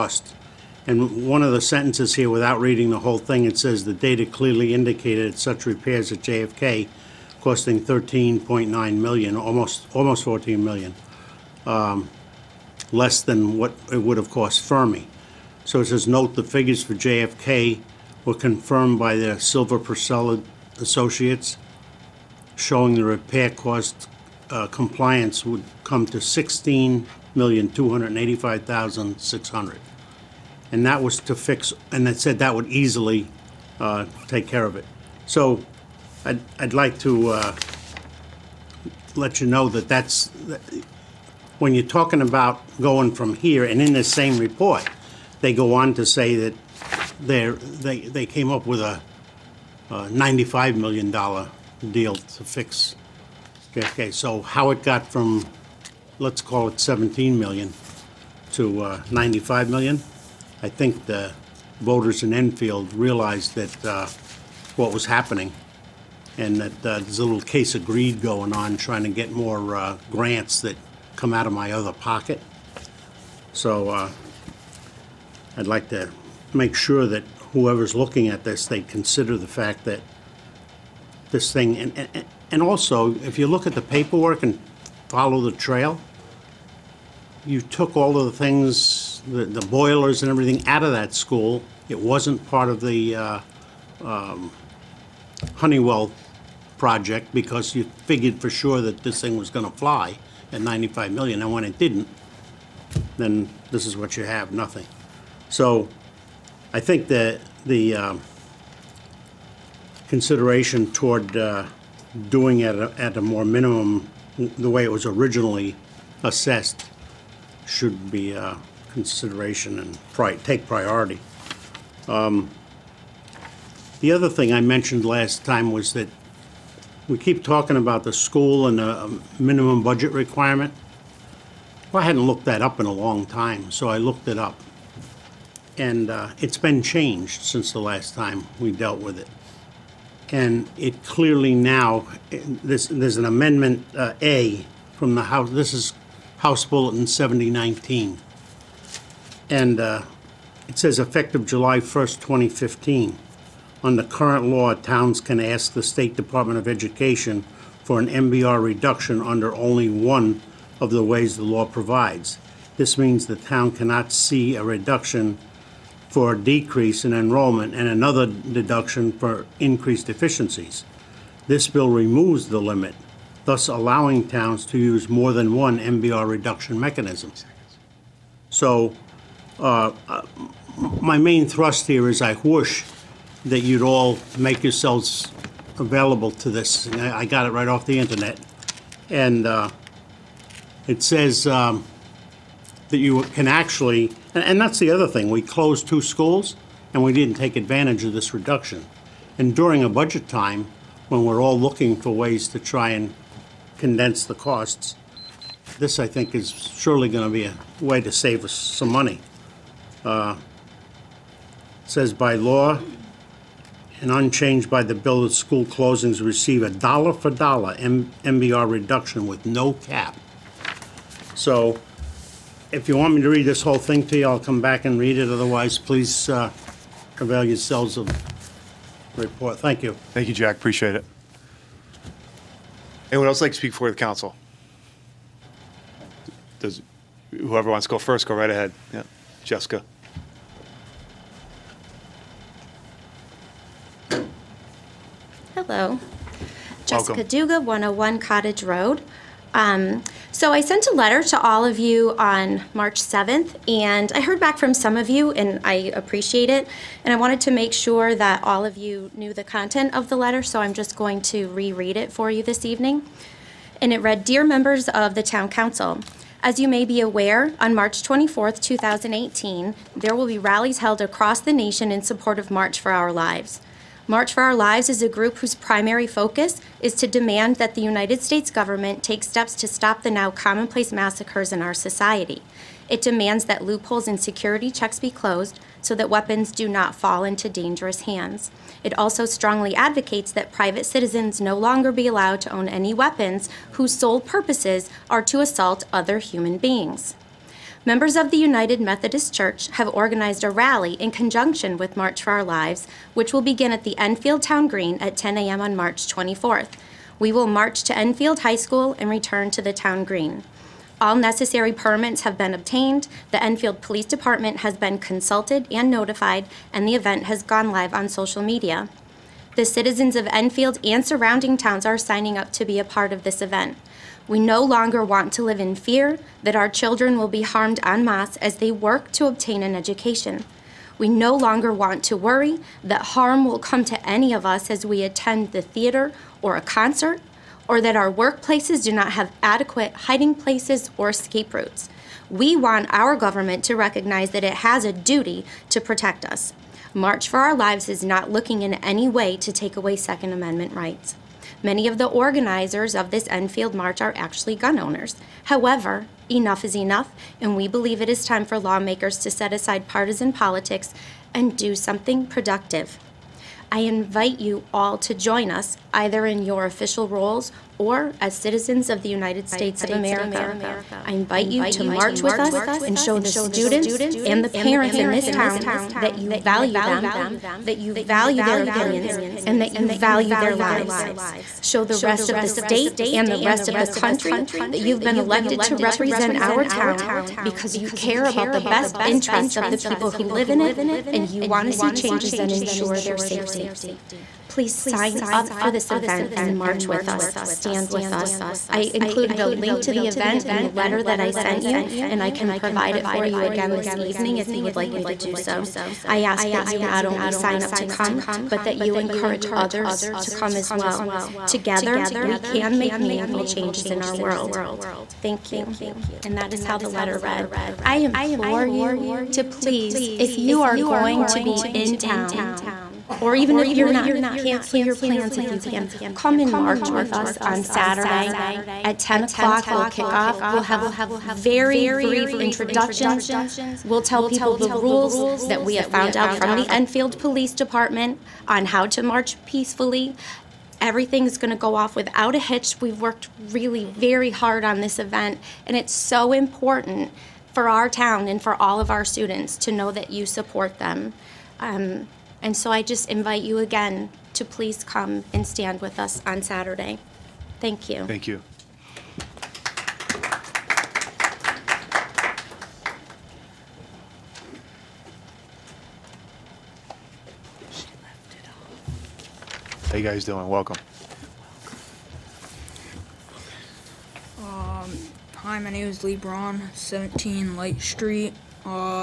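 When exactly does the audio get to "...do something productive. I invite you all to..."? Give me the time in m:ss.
6:01.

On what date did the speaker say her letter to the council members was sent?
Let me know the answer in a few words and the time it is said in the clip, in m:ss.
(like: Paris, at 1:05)
March 7th, at 4:12.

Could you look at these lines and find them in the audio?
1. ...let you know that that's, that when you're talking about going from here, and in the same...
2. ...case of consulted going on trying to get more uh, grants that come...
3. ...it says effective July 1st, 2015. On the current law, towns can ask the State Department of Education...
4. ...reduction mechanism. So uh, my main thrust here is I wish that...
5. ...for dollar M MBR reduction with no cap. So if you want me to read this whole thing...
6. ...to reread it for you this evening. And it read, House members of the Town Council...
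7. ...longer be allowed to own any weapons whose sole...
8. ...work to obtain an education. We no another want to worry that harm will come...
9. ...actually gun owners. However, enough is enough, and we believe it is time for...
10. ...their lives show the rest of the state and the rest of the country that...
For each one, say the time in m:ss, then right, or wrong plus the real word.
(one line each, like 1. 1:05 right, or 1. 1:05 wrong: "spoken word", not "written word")
1. 0:39 right
2. 1:07 wrong: "greed", not "consulted"
3. 2:30 right
4. 2:56 right
5. 3:37 right
6. 4:21 wrong: "Dear", not "House"
7. 4:51 right
8. 5:28 wrong: "longer", not "another"
9. 5:54 right
10. 6:20 right.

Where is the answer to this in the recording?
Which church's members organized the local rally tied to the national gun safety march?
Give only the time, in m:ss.
4:58.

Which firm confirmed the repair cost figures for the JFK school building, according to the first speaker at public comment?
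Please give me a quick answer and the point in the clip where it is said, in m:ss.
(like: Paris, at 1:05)
Silver Purcell Associates, at 0:19.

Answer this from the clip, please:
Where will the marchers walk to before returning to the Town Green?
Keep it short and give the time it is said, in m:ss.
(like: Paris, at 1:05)
Enfield High School, at 5:07.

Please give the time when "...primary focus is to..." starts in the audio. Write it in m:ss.
4:35.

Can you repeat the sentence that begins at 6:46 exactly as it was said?
I ask that you not only sign up to come, but that you encourage others to come as well.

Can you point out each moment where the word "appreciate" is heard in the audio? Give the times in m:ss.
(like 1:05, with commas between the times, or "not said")
3:50, 4:15.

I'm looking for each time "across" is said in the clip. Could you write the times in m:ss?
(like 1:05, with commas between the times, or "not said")
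4:31.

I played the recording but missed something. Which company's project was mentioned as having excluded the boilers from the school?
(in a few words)
Honeywell.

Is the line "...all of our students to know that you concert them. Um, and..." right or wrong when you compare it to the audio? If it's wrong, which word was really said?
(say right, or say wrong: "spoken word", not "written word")
wrong: "support", not "concert".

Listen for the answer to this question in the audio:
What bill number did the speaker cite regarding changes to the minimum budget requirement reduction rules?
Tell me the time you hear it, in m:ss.
2:27.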